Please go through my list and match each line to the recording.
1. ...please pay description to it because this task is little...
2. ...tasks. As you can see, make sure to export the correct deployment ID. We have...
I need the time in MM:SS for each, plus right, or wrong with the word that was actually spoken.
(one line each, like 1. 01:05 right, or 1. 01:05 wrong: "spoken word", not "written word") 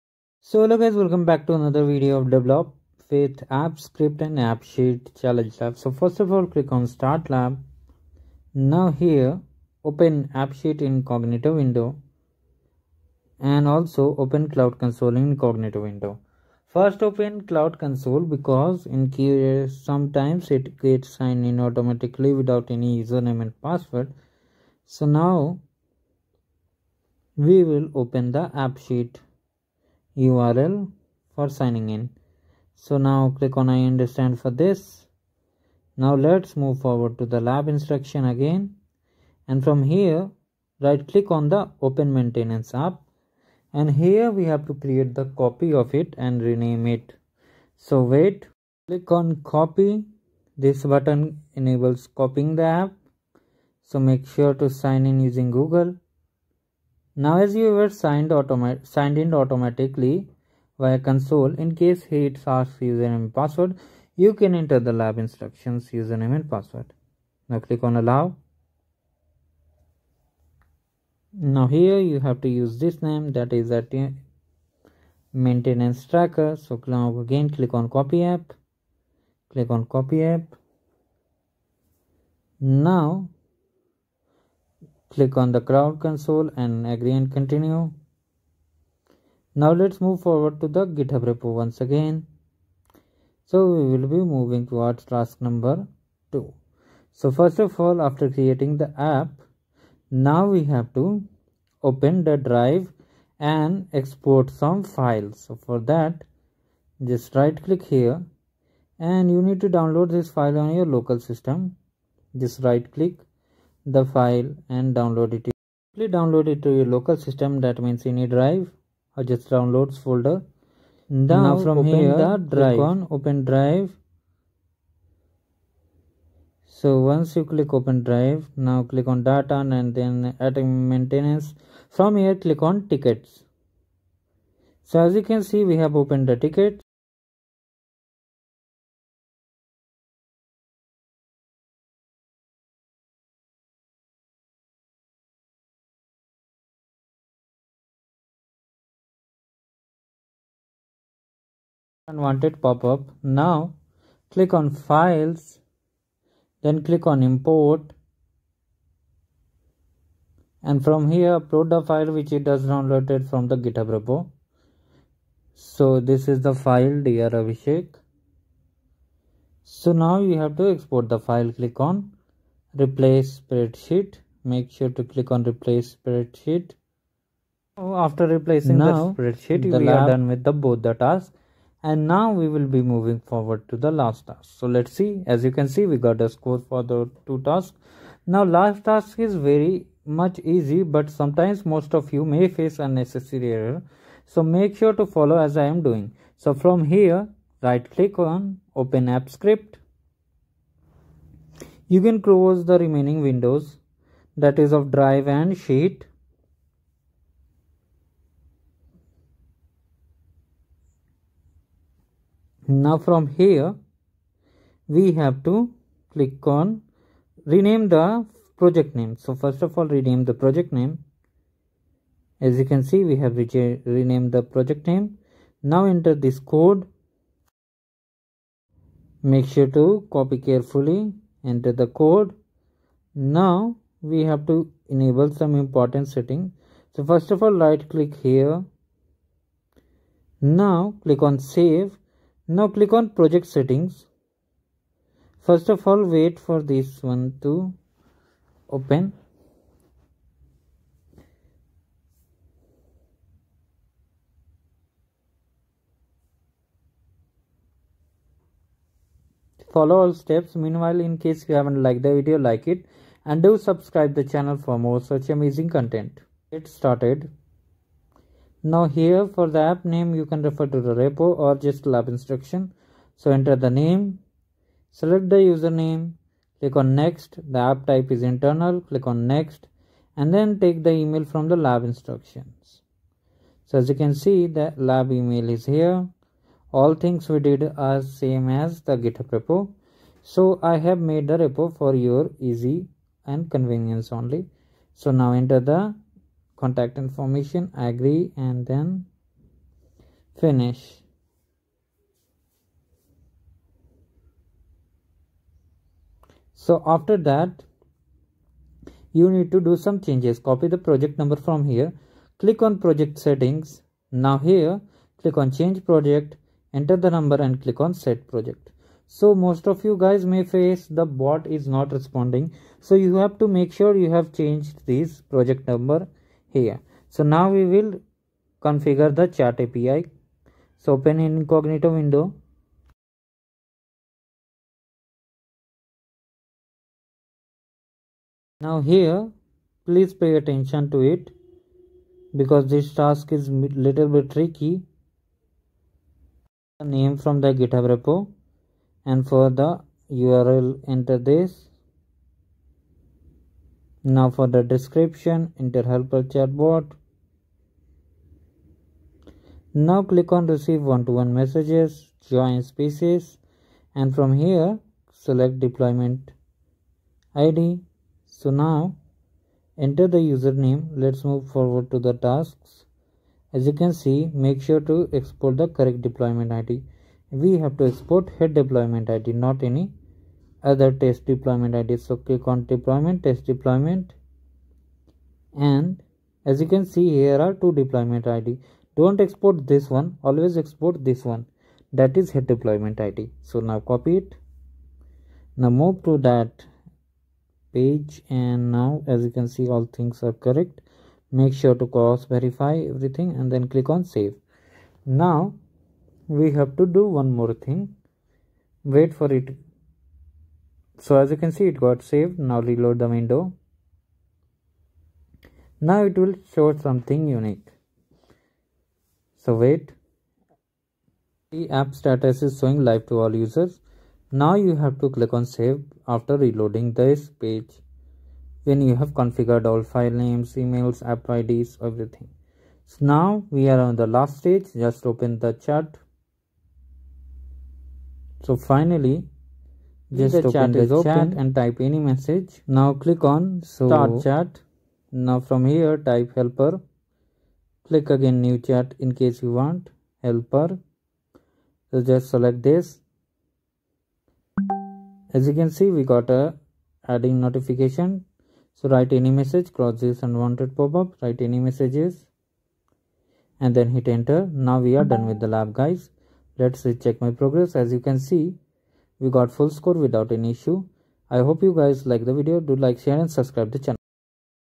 1. 05:39 wrong: "attention", not "description"
2. 06:12 right.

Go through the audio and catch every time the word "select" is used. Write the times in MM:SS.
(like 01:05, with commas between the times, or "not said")
04:34, 06:05, 07:32.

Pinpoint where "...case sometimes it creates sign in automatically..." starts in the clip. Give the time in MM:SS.
00:19.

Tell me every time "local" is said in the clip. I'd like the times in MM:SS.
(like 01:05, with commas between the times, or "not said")
01:50, 01:56.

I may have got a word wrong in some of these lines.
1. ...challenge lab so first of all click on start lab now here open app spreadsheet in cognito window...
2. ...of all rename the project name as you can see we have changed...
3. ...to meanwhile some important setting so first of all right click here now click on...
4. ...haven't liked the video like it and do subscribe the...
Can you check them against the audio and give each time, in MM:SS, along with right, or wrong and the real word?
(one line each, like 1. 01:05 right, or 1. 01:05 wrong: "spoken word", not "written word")
1. 00:05 wrong: "sheet", not "spreadsheet"
2. 03:39 wrong: "renamed", not "changed"
3. 03:54 wrong: "enable", not "meanwhile"
4. 04:21 right.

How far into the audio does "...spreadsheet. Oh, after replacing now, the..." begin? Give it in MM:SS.
02:55.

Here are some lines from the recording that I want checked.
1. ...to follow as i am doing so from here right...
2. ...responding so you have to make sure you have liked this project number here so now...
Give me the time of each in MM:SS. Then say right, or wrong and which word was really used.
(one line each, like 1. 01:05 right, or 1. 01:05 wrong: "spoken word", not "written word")
1. 03:14 right
2. 05:21 wrong: "changed", not "liked".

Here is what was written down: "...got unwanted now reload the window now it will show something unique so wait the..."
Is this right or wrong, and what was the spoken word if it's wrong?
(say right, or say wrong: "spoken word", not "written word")
wrong: "saved", not "unwanted".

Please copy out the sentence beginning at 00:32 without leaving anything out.
So now click on I understand for this.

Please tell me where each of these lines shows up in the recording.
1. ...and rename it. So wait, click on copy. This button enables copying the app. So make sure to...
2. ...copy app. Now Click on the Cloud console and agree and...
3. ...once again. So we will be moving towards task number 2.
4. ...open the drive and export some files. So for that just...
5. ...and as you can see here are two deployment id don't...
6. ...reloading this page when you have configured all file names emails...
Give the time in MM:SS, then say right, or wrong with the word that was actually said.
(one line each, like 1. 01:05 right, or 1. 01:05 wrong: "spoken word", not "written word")
1. 00:46 right
2. 01:19 right
3. 01:31 right
4. 01:41 right
5. 06:25 right
6. 07:06 right.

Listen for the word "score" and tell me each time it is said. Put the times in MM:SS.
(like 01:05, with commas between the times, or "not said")
03:06, 07:49.